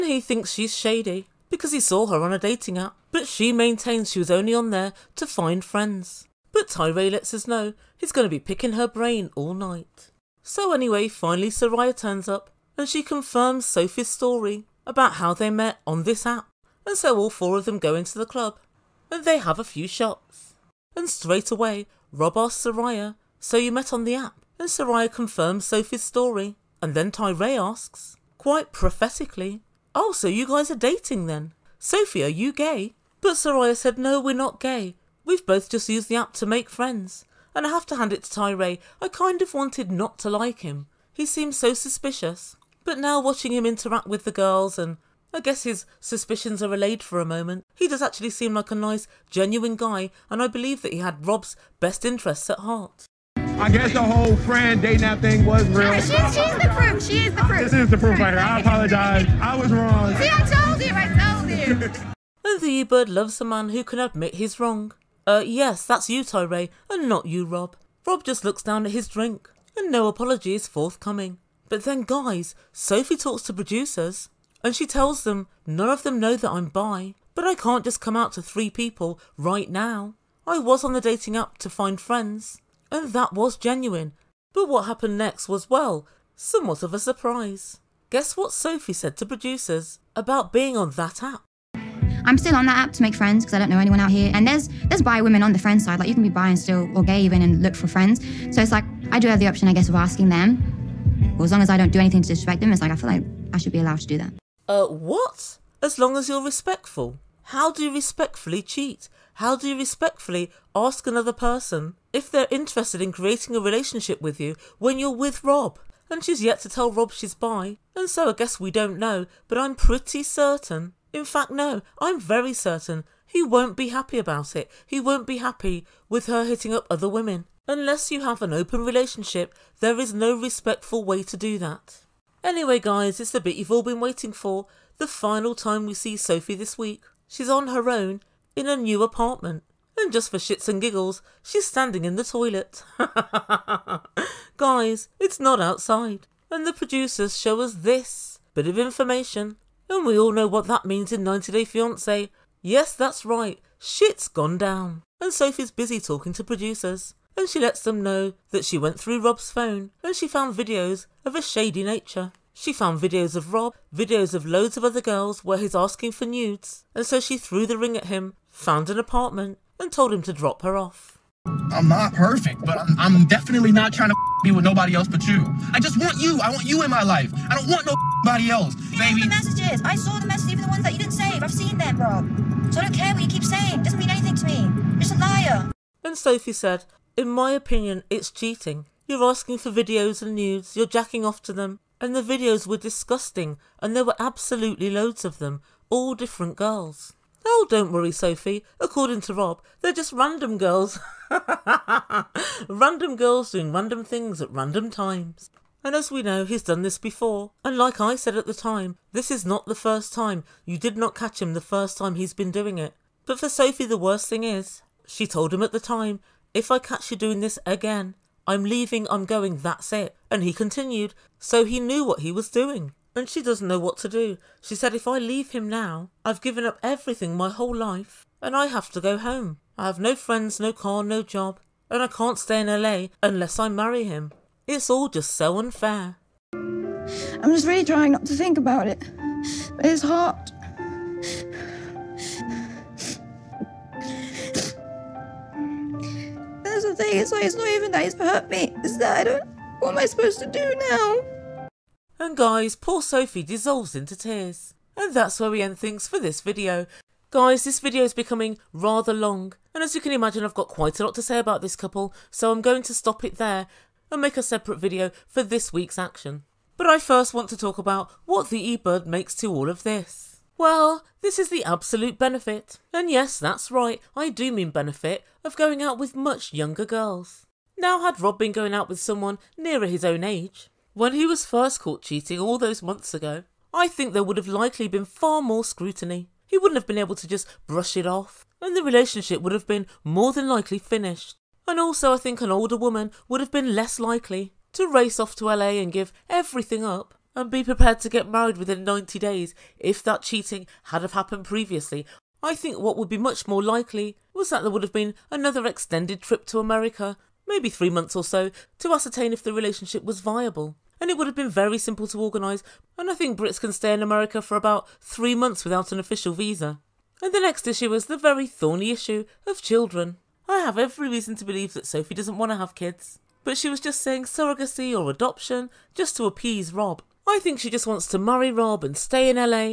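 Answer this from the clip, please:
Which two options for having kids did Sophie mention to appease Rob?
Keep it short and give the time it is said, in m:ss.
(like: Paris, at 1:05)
Surrogacy or adoption, at 5:24.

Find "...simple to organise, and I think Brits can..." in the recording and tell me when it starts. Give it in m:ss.
5:11.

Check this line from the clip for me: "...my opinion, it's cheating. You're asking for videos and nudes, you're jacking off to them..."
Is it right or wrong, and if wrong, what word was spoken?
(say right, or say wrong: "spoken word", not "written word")
right.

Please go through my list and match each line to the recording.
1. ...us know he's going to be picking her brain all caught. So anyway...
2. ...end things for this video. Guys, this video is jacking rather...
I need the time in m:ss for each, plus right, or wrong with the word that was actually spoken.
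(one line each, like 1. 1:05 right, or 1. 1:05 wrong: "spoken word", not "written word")
1. 0:07 wrong: "night", not "caught"
2. 4:15 wrong: "becoming", not "jacking".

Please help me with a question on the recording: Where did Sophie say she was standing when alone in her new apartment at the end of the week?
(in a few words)
In the toilet.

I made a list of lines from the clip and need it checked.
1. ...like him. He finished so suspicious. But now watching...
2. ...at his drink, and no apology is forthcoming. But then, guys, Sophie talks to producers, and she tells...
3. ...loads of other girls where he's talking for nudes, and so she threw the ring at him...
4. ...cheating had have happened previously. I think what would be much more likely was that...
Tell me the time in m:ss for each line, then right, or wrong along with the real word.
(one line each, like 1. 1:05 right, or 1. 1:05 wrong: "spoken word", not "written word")
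1. 0:40 wrong: "seemed", not "finished"
2. 1:08 right
3. 2:44 wrong: "asking", not "talking"
4. 5:00 right.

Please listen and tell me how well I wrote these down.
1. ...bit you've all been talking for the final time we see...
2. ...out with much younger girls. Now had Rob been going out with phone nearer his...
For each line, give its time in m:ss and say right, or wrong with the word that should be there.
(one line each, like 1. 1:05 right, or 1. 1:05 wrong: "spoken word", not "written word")
1. 2:13 wrong: "waiting", not "talking"
2. 4:35 wrong: "someone", not "phone".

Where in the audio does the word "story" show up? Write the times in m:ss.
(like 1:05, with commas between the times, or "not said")
0:14, 0:26.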